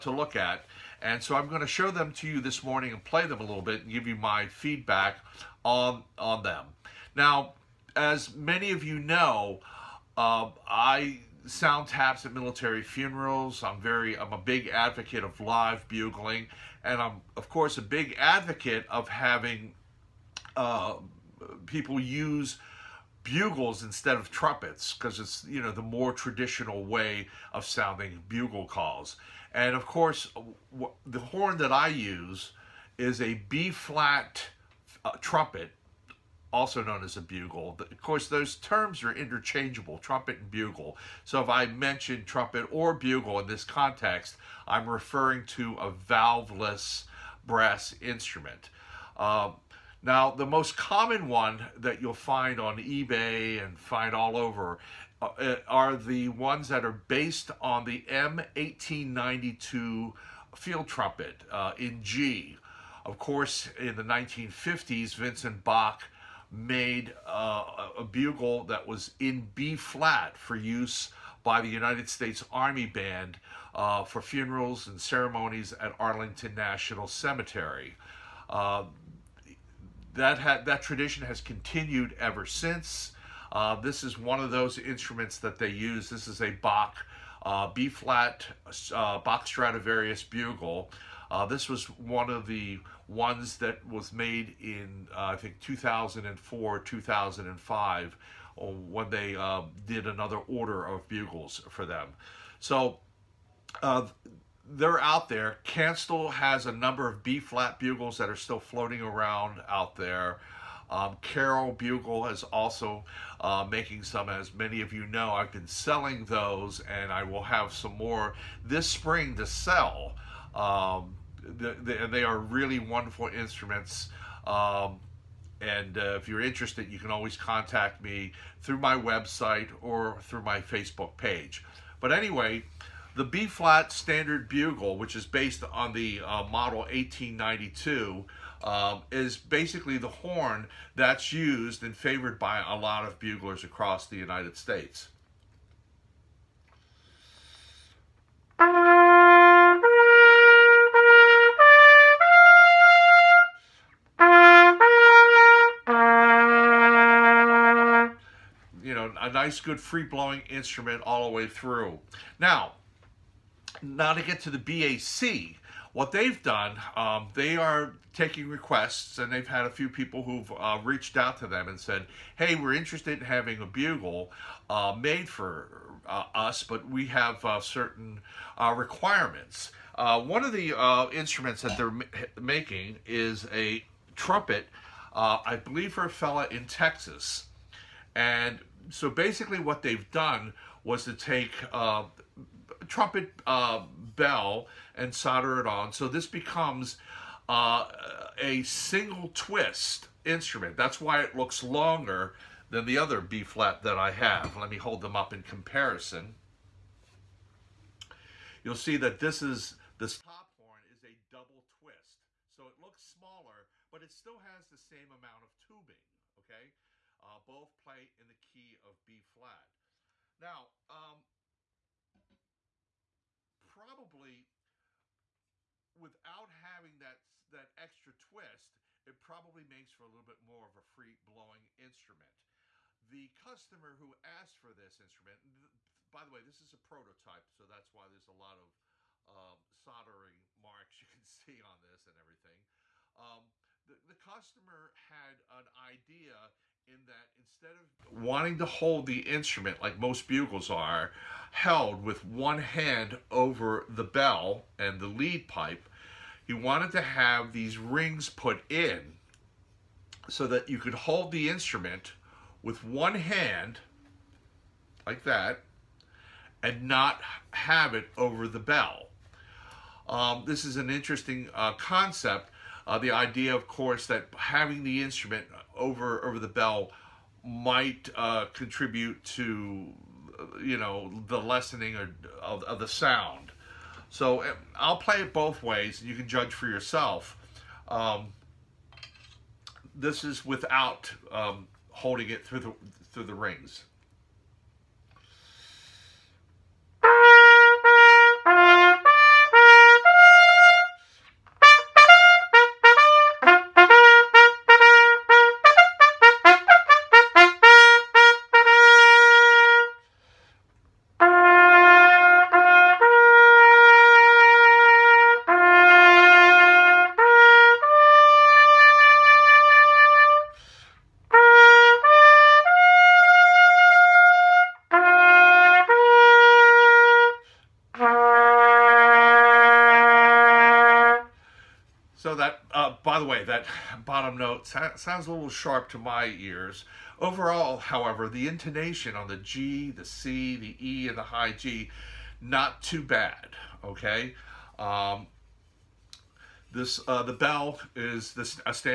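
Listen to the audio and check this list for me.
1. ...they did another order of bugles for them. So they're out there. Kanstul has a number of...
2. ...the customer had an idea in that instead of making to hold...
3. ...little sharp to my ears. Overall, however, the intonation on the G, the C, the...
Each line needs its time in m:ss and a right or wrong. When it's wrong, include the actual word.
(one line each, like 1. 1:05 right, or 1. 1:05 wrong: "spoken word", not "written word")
1. 1:39 right
2. 4:03 wrong: "wanting", not "making"
3. 5:35 right.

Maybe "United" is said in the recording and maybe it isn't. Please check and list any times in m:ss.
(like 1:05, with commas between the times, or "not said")
1:11, 2:24.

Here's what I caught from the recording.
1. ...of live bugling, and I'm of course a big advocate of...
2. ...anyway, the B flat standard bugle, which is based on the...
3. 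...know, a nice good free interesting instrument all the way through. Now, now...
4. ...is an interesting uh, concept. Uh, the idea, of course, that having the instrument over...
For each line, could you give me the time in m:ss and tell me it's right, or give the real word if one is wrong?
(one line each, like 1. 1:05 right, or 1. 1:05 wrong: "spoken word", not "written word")
1. 0:15 right
2. 2:12 right
3. 2:38 wrong: "blowing", not "interesting"
4. 4:30 right.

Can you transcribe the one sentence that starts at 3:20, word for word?
That's why it looks longer than the other B flat that I have.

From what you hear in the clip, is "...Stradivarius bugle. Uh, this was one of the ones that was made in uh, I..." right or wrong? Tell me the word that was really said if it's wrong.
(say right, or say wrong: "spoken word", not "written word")
right.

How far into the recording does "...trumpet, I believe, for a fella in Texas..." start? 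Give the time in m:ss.
3:04.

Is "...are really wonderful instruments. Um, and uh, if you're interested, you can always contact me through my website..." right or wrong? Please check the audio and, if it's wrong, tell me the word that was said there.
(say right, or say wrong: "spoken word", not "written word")
right.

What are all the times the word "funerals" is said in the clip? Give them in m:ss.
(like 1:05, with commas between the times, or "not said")
0:12, 1:14.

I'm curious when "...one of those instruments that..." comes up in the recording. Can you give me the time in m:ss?
1:24.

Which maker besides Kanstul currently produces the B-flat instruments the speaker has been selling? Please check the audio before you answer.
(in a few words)
Carol Bugle.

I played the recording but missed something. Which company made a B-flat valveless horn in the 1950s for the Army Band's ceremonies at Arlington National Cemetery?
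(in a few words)
Vincent Bach.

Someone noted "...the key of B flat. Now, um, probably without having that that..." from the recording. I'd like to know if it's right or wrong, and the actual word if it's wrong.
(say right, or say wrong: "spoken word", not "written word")
right.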